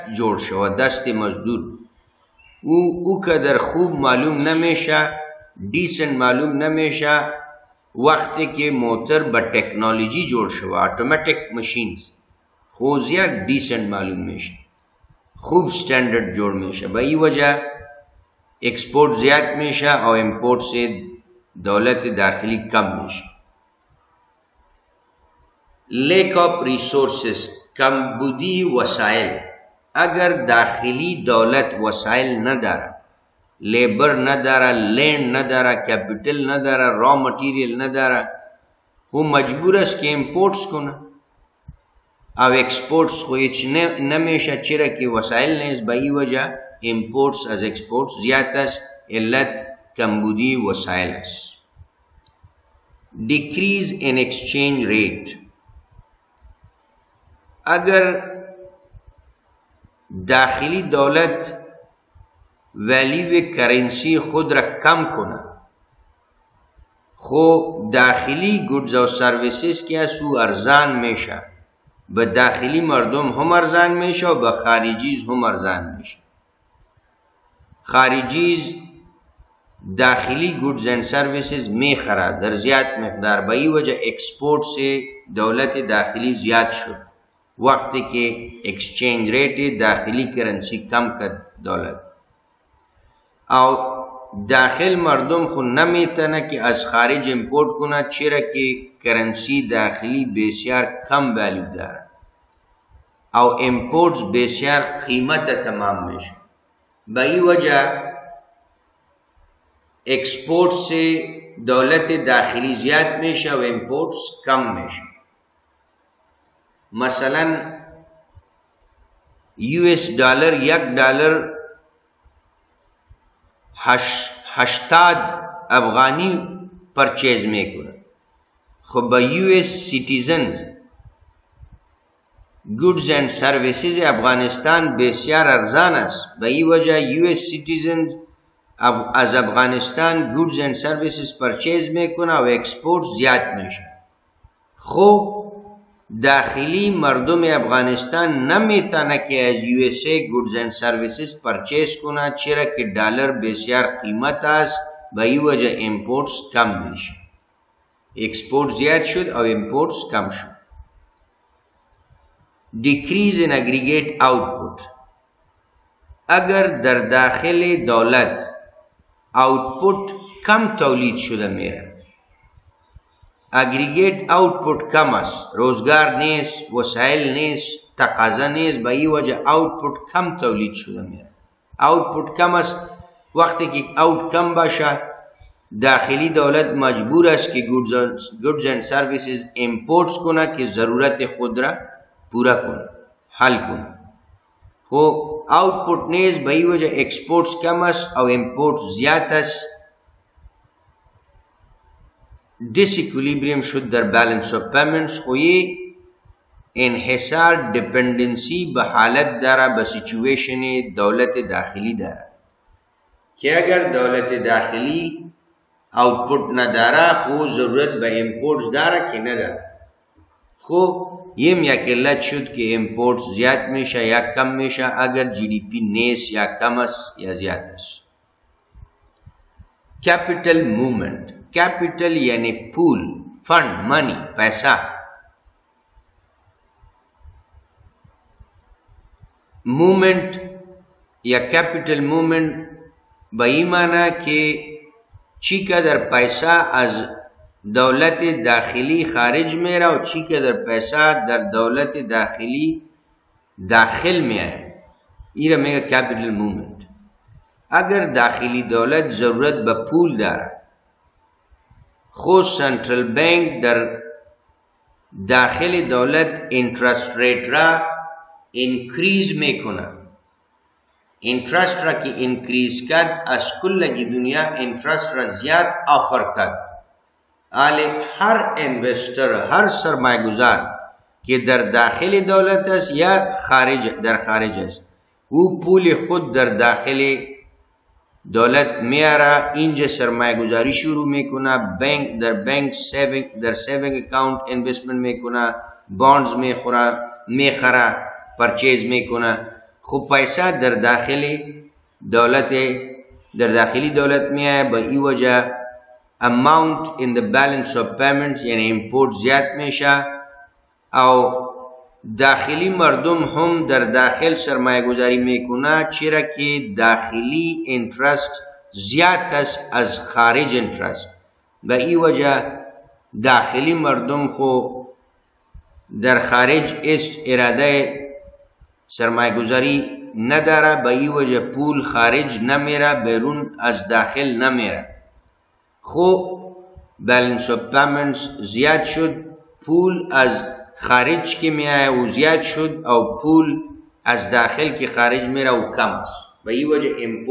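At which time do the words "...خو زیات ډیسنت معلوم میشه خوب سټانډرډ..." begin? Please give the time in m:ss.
0:12.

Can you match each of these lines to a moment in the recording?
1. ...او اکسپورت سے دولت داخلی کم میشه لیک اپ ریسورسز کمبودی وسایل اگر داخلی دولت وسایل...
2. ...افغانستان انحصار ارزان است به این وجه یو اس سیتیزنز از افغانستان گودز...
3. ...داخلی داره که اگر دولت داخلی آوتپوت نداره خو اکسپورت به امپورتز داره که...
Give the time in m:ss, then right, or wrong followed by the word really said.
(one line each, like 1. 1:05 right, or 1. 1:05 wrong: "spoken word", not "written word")
1. 0:20 wrong: "امپورت", not "اکسپورت"
2. 2:13 wrong: "بسیار", not "انحصار"
3. 3:31 wrong: "ضرورت", not "اکسپورت".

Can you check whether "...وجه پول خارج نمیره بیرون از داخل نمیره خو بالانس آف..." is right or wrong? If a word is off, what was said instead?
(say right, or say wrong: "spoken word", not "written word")
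right.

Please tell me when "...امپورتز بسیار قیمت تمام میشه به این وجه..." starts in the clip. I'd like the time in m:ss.
1:43.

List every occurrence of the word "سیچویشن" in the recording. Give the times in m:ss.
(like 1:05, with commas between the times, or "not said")
3:29.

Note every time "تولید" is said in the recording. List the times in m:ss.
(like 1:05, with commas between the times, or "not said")
2:50, 3:00.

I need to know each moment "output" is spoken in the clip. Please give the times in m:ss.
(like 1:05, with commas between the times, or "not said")
2:44, 2:49.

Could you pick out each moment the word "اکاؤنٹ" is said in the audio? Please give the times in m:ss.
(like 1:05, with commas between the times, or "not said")
4:54.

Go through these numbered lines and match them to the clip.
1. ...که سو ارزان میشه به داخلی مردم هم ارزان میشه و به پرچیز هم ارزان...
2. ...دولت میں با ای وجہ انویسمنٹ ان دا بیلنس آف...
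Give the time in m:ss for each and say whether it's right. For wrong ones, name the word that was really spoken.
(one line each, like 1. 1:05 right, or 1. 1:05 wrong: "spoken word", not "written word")
1. 1:09 wrong: "خارجیز", not "پرچیز"
2. 5:03 wrong: "اماؤنٹ", not "انویسمنٹ".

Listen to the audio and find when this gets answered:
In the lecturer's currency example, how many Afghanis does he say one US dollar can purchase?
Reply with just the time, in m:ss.
2:04.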